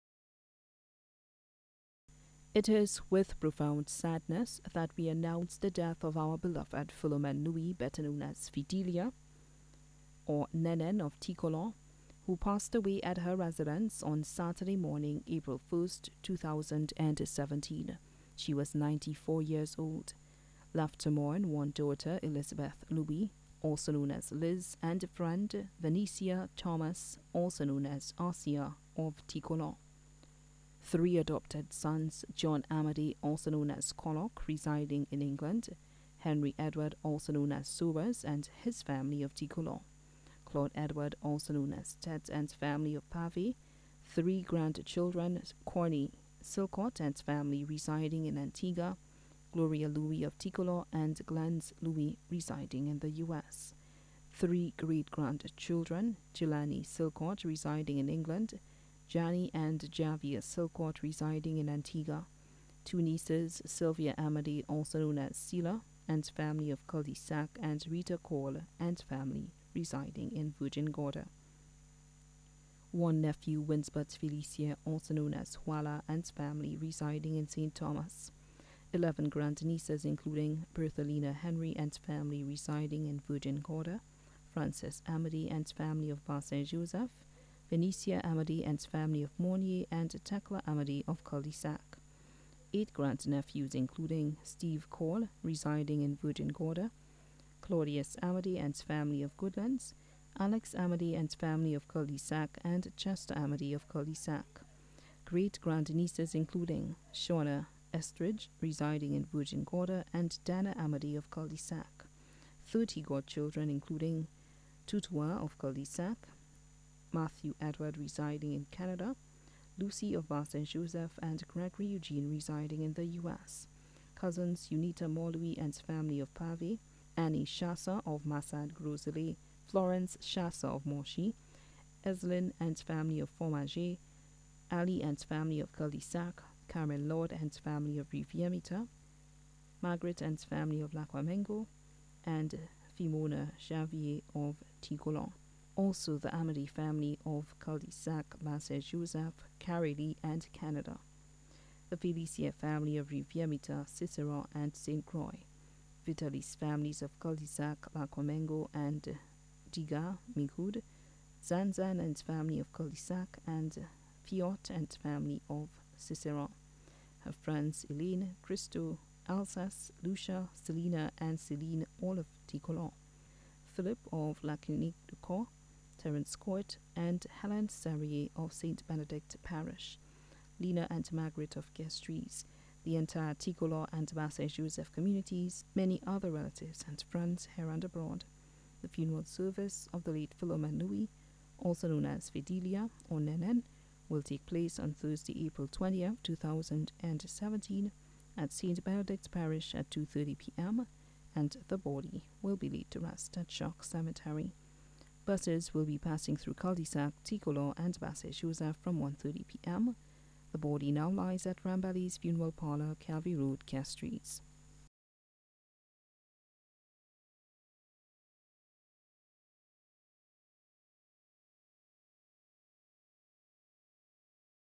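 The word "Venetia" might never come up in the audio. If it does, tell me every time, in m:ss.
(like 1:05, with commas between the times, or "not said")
0:25, 1:27.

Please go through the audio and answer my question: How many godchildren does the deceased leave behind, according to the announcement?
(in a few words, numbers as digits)
30.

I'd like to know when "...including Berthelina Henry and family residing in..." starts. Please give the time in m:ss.
1:20.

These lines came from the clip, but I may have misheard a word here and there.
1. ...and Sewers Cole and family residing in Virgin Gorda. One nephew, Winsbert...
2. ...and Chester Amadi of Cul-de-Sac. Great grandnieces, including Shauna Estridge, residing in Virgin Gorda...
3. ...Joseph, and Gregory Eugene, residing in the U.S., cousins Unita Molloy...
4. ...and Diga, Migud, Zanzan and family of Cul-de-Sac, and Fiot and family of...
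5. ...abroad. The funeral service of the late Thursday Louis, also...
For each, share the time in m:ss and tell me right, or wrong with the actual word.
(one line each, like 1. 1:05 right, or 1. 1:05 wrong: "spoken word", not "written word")
1. 1:07 wrong: "Rita", not "Sewers"
2. 1:42 right
3. 2:00 right
4. 2:38 right
5. 3:07 wrong: "Philomene", not "Thursday".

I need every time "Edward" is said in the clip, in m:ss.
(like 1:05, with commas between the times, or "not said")
0:36, 0:40, 1:57.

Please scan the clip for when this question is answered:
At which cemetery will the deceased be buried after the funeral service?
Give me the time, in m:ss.
3:23.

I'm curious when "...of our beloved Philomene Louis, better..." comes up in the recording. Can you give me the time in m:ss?
0:06.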